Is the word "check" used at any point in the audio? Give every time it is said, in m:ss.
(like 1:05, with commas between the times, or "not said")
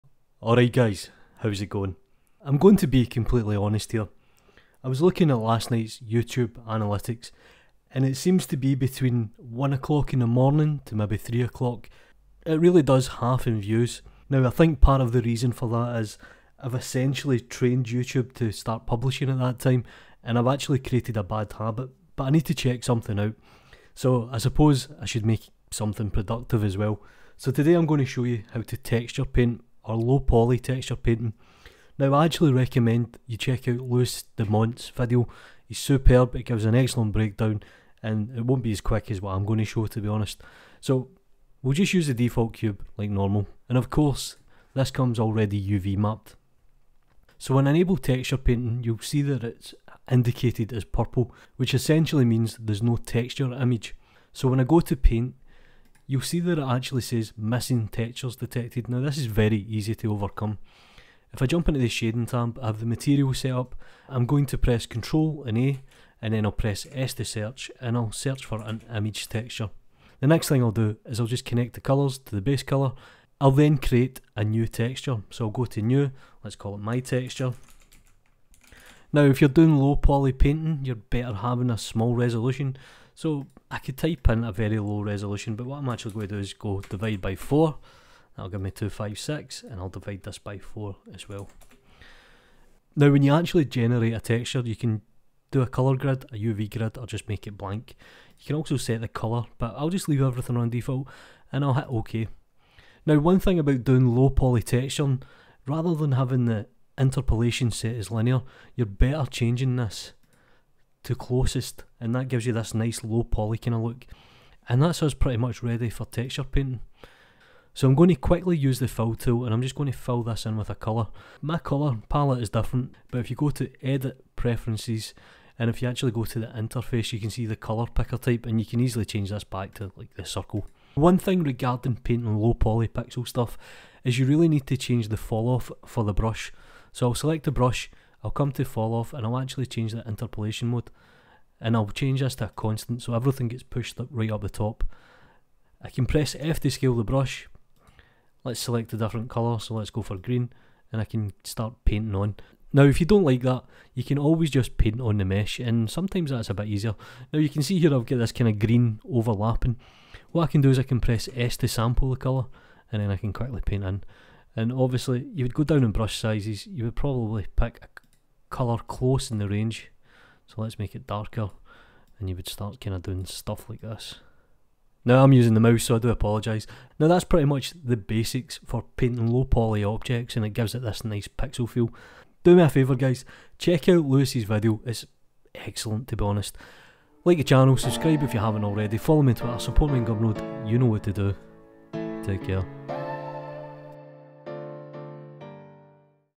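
0:22, 0:33, 3:03.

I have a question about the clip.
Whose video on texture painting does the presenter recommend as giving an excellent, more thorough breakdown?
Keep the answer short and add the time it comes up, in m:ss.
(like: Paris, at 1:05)
Louis du Mont, at 0:33.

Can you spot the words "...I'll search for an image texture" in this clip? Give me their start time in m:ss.
1:07.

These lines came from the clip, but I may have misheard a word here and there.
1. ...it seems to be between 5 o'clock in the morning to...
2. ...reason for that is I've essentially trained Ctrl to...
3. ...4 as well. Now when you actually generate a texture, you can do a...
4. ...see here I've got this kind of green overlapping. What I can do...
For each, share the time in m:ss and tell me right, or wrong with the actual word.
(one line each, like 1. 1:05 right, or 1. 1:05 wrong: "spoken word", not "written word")
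1. 0:08 wrong: "1", not "5"
2. 0:15 wrong: "YouTube", not "Ctrl"
3. 1:30 right
4. 2:37 right.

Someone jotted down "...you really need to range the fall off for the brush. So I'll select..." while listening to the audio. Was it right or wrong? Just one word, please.
wrong.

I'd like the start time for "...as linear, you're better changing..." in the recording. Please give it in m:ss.
1:47.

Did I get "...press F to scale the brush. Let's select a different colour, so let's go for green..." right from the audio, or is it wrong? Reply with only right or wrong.
right.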